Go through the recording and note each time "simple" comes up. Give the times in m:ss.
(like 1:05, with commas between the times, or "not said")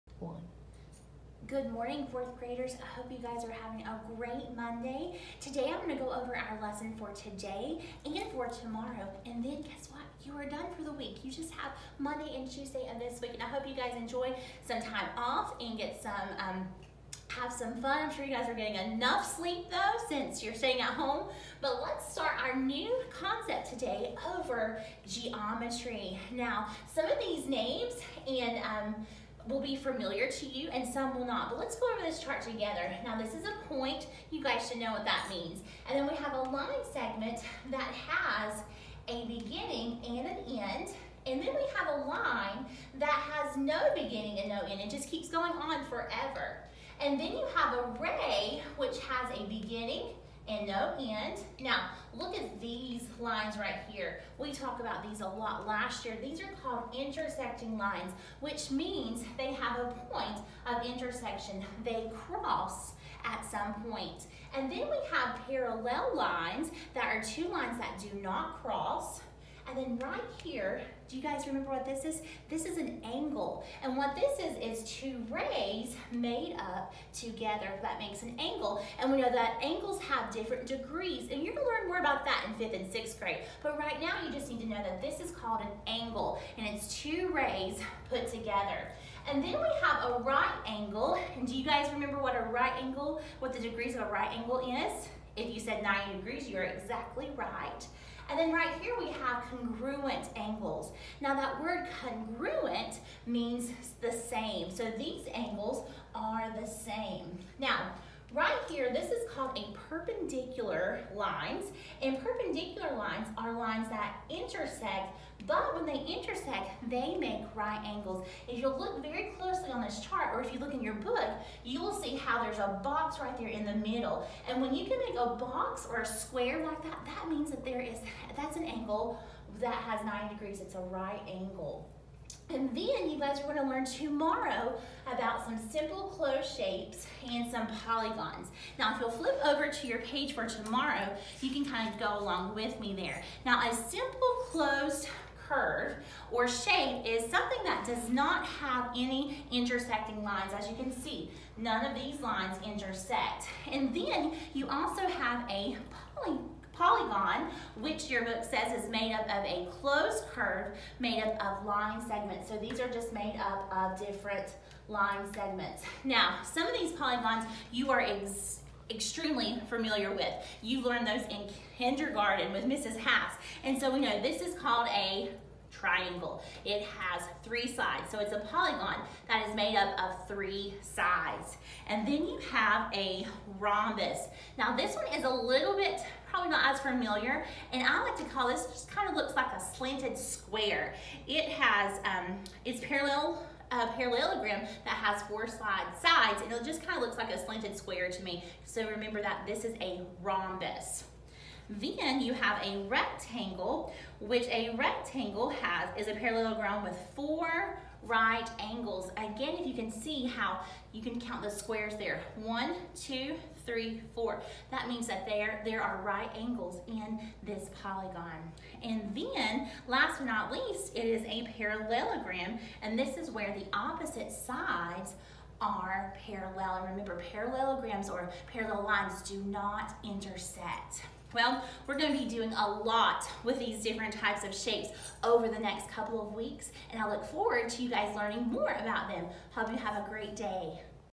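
2:15, 2:23.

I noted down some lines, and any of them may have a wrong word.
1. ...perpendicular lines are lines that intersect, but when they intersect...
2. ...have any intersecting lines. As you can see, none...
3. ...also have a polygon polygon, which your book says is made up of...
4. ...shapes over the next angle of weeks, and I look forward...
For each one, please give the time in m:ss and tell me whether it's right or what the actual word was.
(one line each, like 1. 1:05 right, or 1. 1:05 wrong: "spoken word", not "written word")
1. 1:52 right
2. 2:28 right
3. 2:34 right
4. 3:54 wrong: "couple", not "angle".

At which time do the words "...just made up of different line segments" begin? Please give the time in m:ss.
2:42.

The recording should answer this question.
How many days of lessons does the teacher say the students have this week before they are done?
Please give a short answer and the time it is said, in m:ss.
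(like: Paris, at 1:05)
2, at 0:11.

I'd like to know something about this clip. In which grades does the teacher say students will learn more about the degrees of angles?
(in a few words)
fifth and sixth grade.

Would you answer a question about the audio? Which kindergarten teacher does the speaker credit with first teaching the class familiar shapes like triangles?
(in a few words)
Mrs. Haas.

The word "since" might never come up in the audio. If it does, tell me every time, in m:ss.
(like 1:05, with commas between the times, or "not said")
0:20.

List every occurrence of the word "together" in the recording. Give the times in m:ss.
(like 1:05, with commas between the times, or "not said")
0:32, 1:17, 1:28.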